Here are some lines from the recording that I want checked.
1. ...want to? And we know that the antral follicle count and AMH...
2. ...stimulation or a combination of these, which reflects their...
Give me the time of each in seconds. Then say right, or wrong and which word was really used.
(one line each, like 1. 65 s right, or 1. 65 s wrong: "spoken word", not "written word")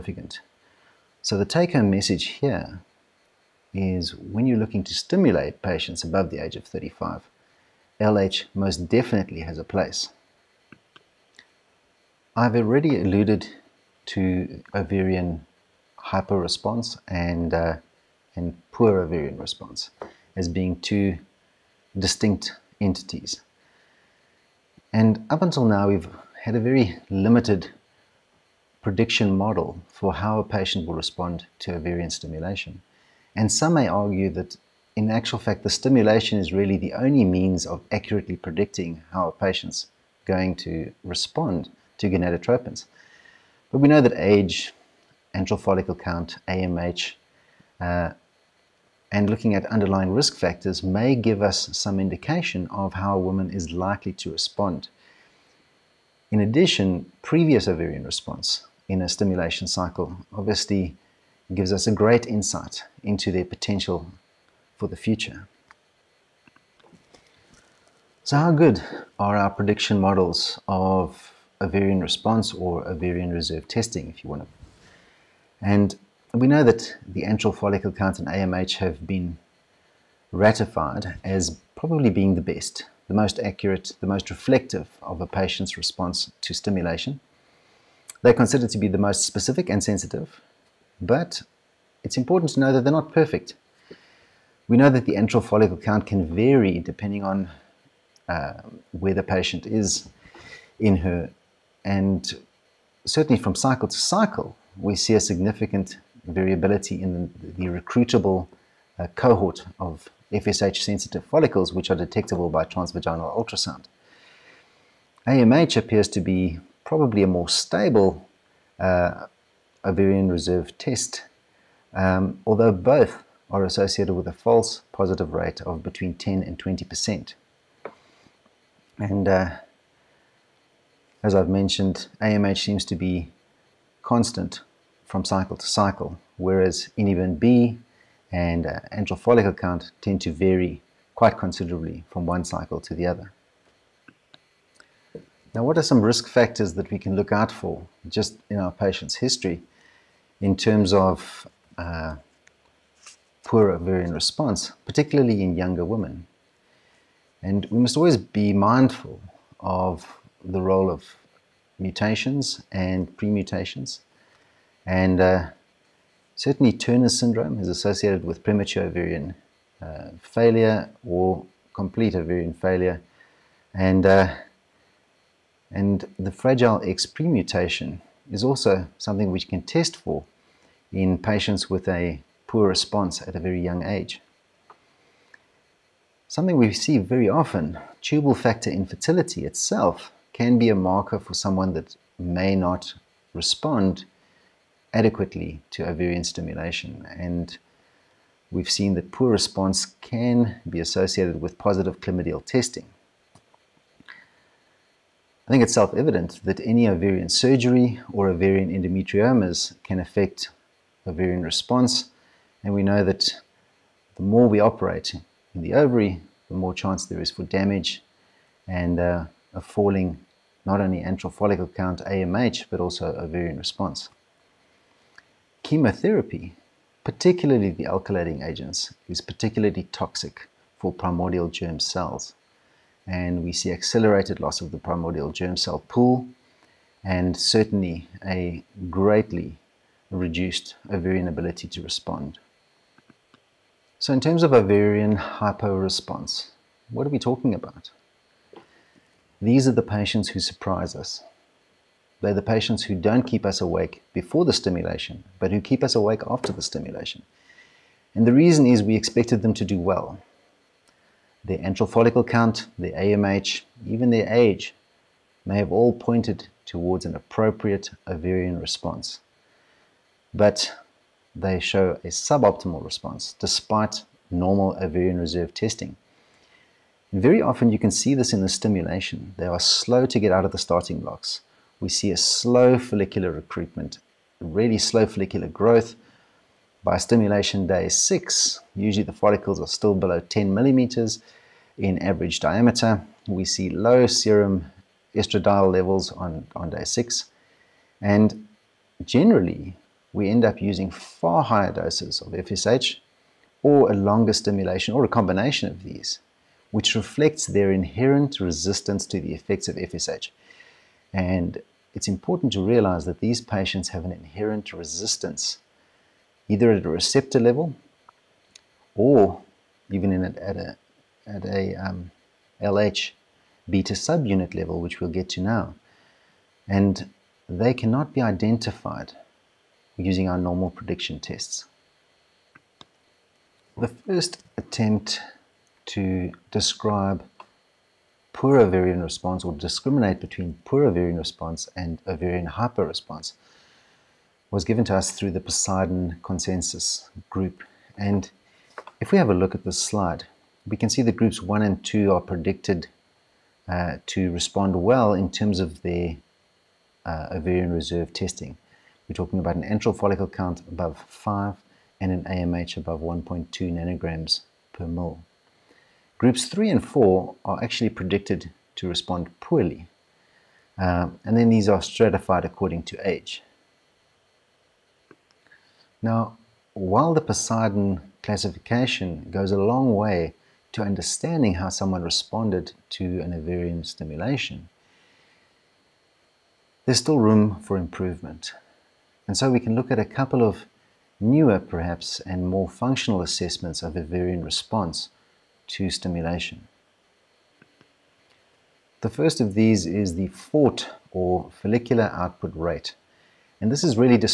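1. 74 s right
2. 304 s right.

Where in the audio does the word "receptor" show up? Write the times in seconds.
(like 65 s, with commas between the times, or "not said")
316 s.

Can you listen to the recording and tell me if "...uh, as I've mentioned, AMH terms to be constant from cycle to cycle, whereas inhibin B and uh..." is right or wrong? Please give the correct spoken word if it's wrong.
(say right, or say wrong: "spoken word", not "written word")
wrong: "seems", not "terms".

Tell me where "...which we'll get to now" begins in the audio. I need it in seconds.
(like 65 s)
324 s.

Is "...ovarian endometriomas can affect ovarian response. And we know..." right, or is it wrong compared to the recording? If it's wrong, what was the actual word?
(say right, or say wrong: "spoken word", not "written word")
right.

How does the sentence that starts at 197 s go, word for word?
And we've seen that poor response can be associated with positive chlamydial testing.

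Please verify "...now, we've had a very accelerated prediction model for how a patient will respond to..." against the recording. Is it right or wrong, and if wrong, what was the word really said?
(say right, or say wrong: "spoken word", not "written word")
wrong: "limited", not "accelerated".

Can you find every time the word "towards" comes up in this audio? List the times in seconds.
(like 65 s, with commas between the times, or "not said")
266 s.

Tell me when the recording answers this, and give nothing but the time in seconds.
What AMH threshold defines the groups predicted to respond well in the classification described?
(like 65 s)
362 s.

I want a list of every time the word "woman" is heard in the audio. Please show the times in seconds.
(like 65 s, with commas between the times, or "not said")
53 s.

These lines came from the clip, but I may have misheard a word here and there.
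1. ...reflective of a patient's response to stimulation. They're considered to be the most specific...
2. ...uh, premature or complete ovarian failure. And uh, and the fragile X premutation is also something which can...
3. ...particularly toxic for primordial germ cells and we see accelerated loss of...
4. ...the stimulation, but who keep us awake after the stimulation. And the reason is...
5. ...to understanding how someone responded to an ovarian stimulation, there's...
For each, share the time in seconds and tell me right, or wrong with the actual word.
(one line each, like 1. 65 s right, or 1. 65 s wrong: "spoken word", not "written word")
1. 84 s right
2. 169 s wrong: "failure", not "premature"
3. 229 s right
4. 254 s right
5. 380 s right.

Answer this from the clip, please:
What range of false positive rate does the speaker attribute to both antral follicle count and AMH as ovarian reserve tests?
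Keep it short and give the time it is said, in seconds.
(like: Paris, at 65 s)
10 to 20%, at 125 s.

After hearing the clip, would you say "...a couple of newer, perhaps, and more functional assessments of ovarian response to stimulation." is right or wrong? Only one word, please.
right.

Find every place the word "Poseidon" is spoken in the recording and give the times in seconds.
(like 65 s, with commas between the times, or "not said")
345 s, 377 s.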